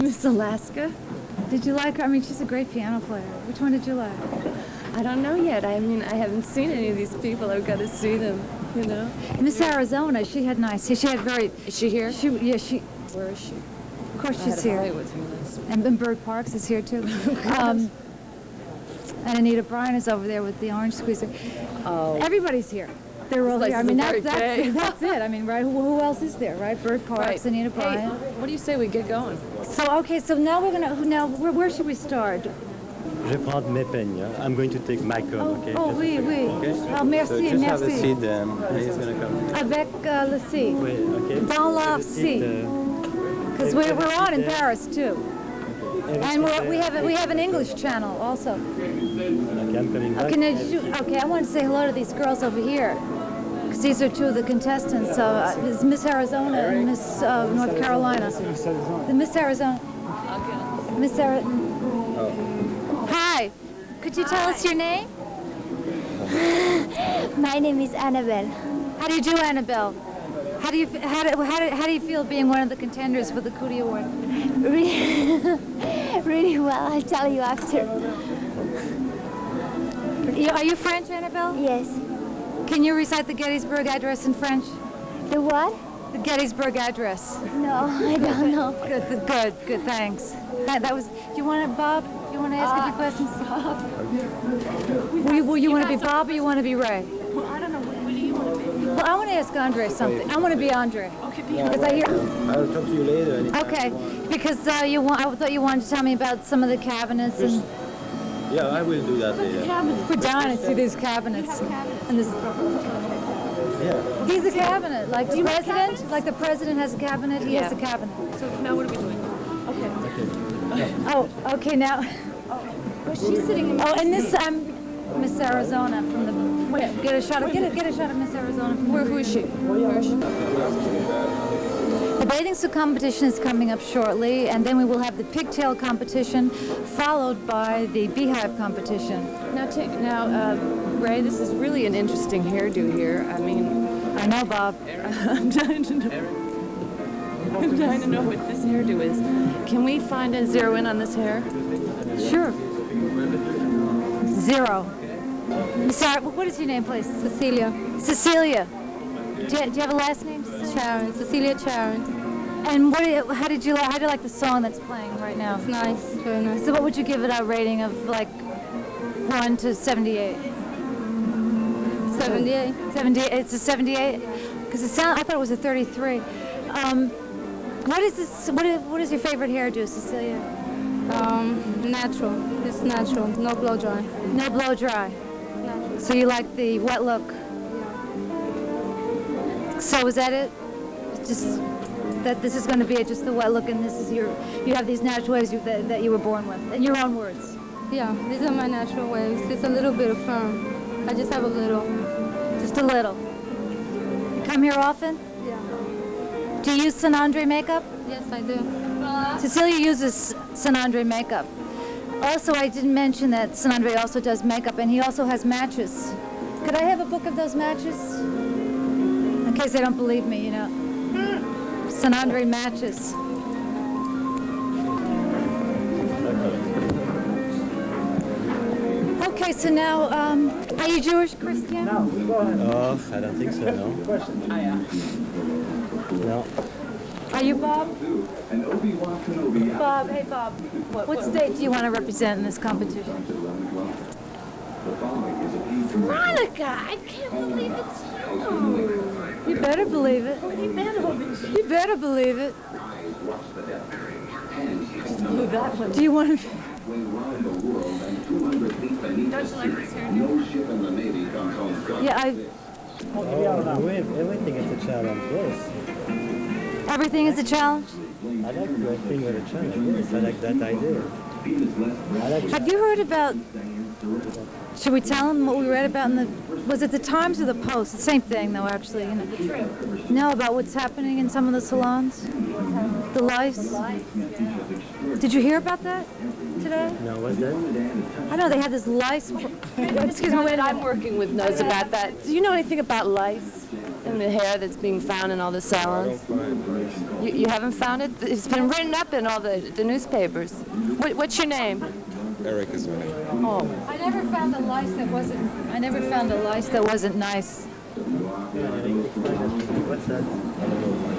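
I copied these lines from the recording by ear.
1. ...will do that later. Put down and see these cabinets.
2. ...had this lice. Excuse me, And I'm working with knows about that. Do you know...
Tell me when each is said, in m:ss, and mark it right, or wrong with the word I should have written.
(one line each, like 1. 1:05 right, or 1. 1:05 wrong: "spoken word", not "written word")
1. 1:48 right
2. 4:48 wrong: "When", not "And".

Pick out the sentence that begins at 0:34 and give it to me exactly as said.
I'm going to take my coat.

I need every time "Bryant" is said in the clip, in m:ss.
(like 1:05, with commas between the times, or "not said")
0:19, 0:27.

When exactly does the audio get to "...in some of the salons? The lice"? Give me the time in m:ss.
4:41.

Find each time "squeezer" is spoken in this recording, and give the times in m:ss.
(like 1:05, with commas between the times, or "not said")
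0:20.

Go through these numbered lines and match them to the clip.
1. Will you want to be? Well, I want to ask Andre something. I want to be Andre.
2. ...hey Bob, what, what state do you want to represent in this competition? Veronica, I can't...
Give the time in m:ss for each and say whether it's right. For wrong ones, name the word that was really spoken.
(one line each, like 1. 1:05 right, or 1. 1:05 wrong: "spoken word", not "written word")
1. 1:37 right
2. 4:00 right.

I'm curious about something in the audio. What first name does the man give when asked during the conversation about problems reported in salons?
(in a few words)
Eric.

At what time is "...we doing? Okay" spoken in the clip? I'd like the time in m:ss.
1:58.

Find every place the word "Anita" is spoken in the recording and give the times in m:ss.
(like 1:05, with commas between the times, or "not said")
0:19, 0:27.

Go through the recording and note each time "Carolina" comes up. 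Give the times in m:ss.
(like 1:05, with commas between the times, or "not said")
0:57.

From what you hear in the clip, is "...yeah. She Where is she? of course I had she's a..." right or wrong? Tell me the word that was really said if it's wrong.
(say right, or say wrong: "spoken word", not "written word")
right.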